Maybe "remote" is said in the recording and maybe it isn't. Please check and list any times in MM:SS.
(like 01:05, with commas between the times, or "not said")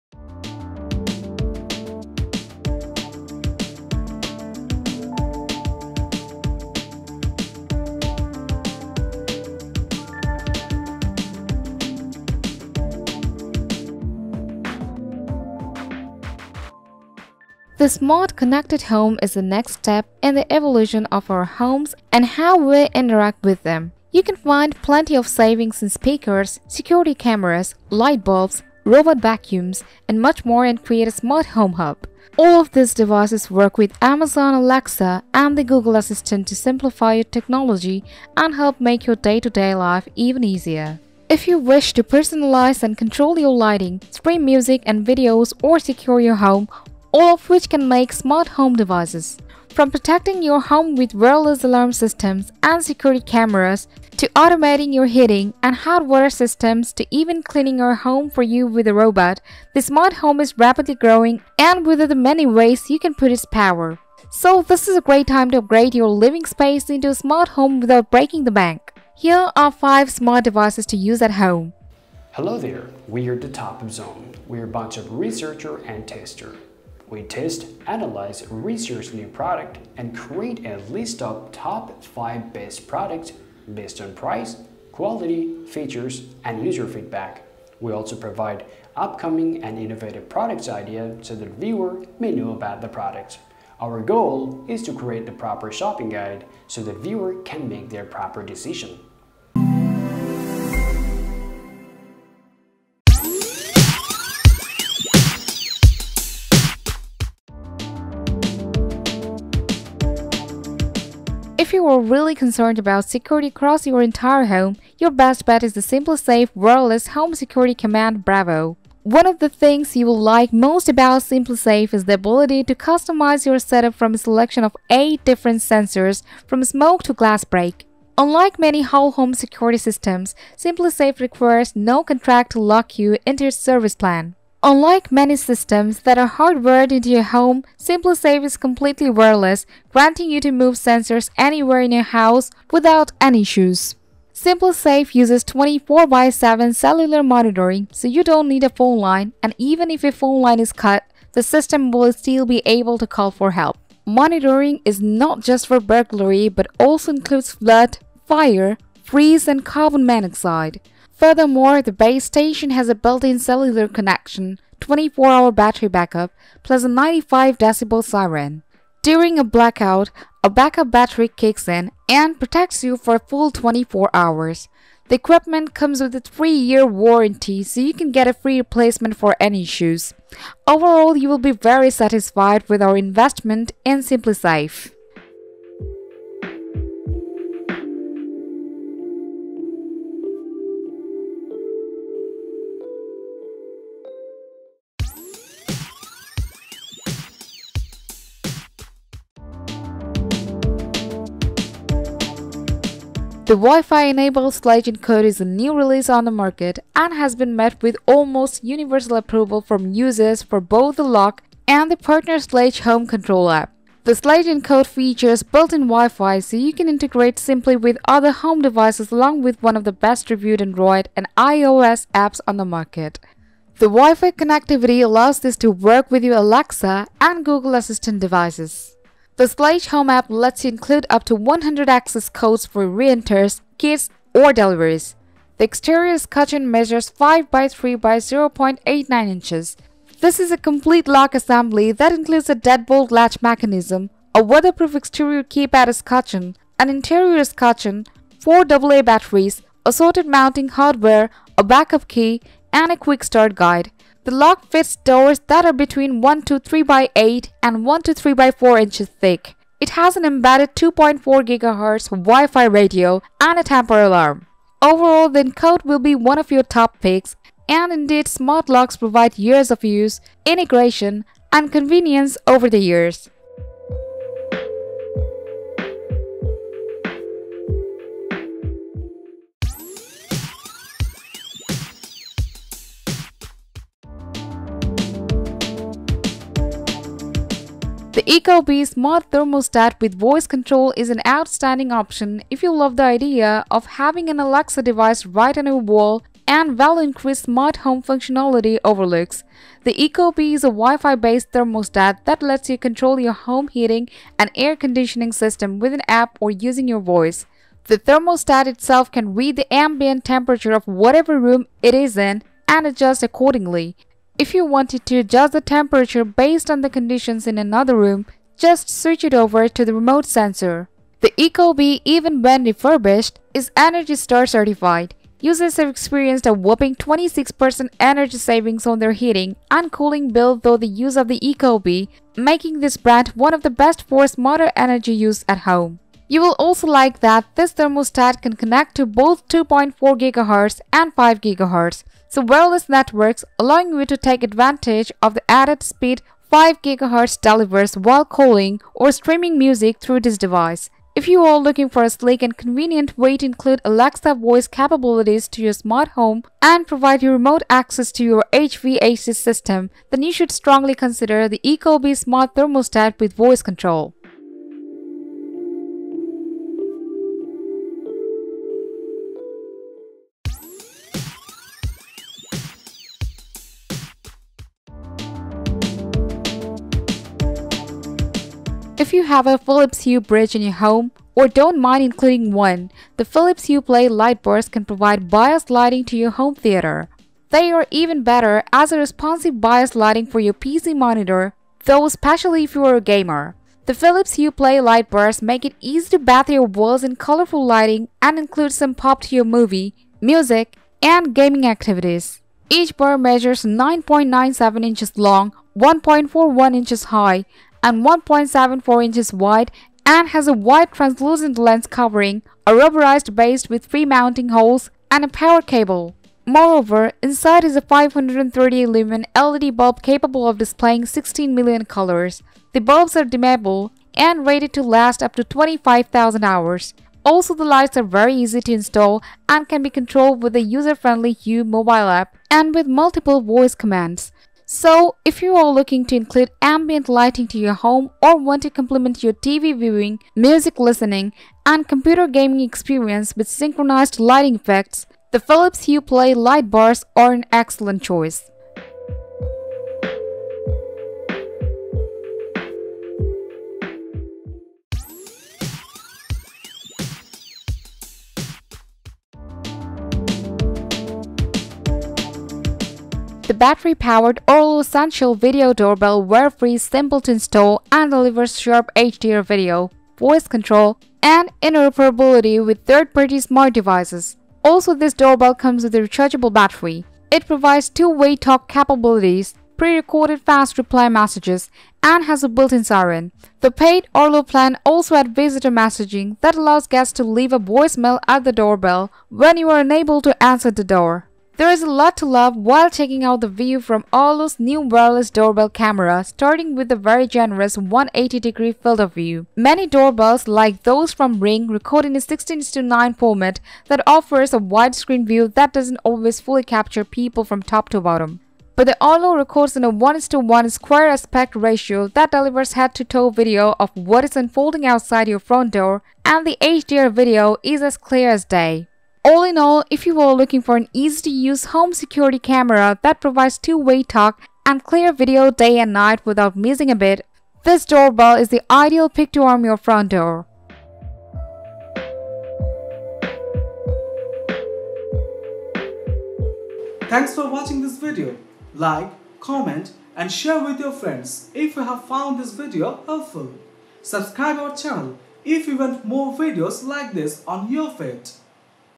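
05:19, 05:57.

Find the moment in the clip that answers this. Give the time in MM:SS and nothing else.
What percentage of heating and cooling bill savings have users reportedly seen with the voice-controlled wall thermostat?
05:26.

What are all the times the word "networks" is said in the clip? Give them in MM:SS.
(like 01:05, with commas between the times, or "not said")
05:42.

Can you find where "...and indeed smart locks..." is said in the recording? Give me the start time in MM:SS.
04:27.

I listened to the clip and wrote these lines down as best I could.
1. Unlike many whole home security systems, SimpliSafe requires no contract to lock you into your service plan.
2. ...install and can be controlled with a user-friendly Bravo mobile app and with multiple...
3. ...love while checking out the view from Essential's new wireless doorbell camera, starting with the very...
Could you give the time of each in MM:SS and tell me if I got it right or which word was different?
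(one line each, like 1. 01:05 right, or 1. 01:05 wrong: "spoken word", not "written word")
1. 02:08 right
2. 07:08 wrong: "Hue", not "Bravo"
3. 08:12 wrong: "Arlo", not "Essential".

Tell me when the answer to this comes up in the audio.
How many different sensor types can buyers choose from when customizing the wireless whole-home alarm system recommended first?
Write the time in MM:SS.
02:04.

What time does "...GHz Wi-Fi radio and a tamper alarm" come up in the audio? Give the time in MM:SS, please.
04:21.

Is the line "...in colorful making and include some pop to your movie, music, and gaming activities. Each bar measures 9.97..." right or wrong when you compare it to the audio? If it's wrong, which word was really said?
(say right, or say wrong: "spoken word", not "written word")
wrong: "lighting", not "making".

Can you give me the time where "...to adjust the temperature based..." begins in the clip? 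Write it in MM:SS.
05:15.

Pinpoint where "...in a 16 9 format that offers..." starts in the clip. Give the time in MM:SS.
08:22.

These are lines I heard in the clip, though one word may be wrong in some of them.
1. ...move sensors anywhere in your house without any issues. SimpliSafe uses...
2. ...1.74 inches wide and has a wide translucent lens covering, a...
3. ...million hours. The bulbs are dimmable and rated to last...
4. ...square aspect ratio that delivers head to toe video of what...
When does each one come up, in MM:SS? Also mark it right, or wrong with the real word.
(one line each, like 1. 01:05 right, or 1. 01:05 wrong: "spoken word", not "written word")
1. 02:20 right
2. 06:48 right
3. 07:01 wrong: "colors", not "hours"
4. 08:30 right.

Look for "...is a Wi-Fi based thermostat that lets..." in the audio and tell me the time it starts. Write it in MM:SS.
05:00.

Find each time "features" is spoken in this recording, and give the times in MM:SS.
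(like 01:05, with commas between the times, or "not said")
01:25, 03:34.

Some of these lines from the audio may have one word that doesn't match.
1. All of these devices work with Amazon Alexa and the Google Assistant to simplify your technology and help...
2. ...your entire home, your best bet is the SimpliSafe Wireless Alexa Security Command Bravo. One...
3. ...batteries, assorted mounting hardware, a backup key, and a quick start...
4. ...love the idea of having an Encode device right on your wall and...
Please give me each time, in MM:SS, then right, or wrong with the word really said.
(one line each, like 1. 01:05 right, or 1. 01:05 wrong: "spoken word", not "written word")
1. 00:32 right
2. 01:53 wrong: "Home", not "Alexa"
3. 04:09 right
4. 04:52 wrong: "Alexa", not "Encode".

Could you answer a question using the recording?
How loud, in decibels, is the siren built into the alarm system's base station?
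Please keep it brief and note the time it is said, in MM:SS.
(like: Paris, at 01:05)
95 decibels, at 02:46.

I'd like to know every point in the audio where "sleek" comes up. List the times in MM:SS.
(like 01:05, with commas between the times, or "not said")
05:52.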